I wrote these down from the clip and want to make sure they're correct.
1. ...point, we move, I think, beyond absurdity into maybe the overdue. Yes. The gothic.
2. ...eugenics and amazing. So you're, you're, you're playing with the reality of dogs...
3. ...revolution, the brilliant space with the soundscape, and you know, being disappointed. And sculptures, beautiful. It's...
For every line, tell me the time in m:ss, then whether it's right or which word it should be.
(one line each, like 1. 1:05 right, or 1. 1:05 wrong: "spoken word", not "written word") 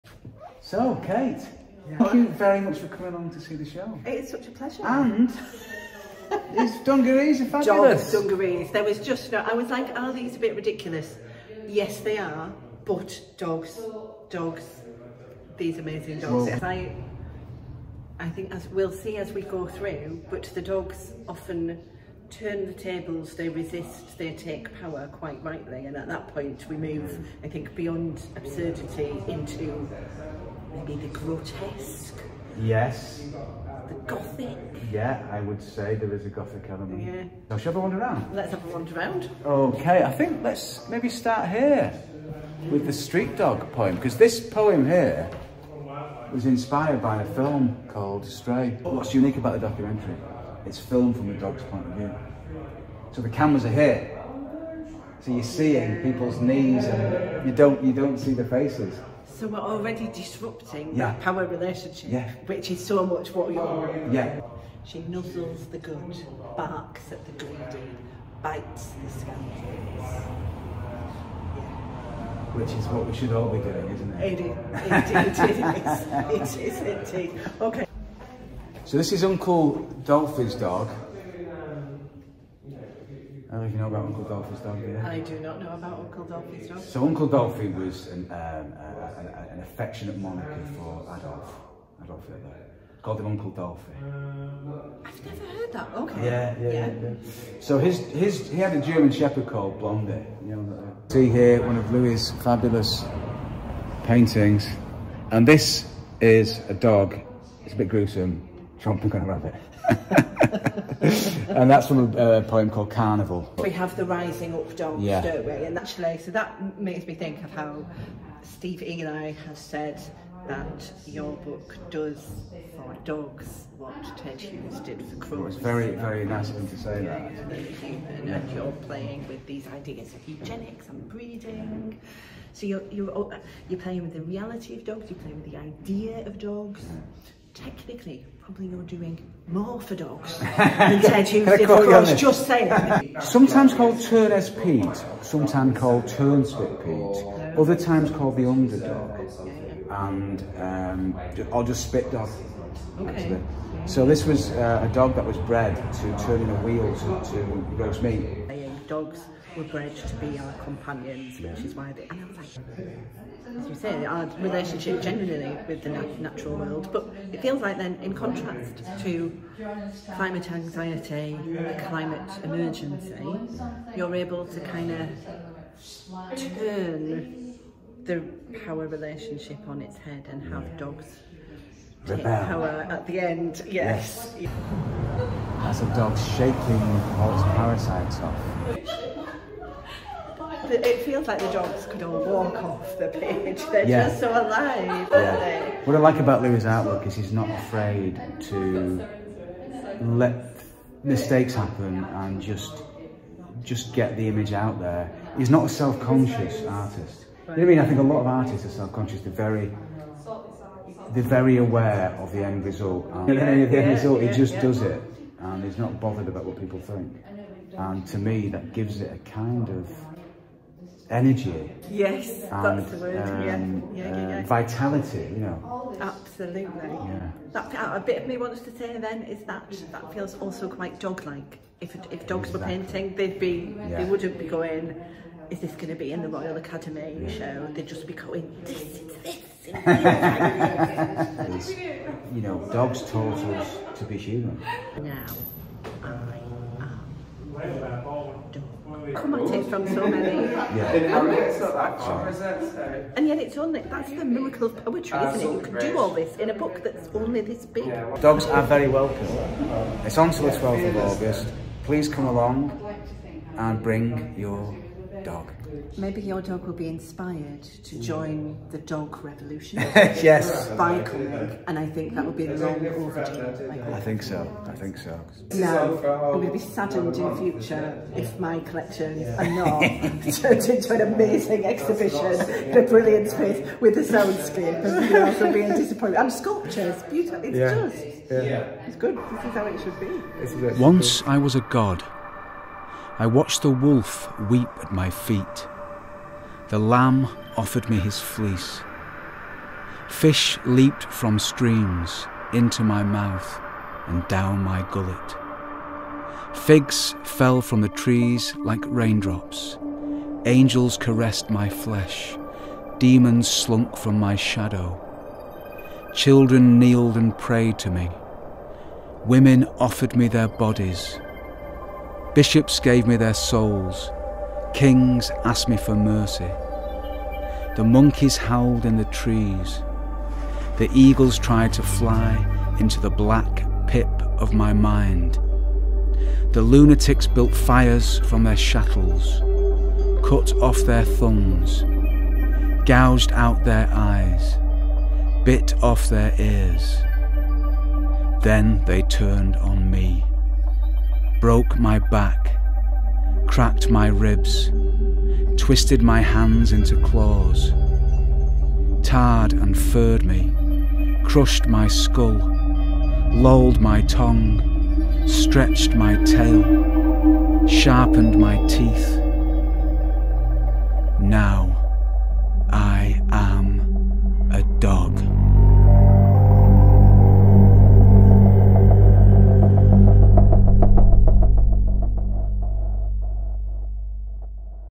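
1. 0:26 wrong: "grotesque", not "overdue"
2. 2:10 wrong: "breeding", not "amazing"
3. 4:41 wrong: "exhibition", not "revolution".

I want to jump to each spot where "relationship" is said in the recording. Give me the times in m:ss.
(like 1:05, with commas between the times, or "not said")
1:01, 2:44, 2:58.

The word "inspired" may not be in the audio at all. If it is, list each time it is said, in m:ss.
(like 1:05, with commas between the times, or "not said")
0:46, 4:26.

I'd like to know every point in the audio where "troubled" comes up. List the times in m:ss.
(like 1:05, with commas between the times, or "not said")
not said.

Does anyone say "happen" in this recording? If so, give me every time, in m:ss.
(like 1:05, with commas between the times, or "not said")
3:21.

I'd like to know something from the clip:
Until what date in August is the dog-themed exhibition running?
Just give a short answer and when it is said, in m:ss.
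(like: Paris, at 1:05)
12th of August, at 4:20.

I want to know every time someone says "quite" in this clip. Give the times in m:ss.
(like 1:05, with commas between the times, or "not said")
0:25, 3:50.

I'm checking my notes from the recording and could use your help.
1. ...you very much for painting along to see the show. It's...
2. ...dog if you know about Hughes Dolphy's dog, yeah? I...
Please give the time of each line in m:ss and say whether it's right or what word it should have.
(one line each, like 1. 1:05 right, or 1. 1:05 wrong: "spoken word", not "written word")
1. 0:02 wrong: "coming", not "painting"
2. 1:20 wrong: "Uncle", not "Hughes".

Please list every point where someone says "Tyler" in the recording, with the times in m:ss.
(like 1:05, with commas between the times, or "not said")
not said.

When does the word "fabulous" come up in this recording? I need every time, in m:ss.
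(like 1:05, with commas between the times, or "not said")
0:07, 1:42.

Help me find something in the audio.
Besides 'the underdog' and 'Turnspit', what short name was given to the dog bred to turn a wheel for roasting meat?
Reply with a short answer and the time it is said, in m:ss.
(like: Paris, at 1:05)
Spit Dog, at 2:31.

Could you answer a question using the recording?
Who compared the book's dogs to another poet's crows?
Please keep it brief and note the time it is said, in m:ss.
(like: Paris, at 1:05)
Steve Ely, at 1:58.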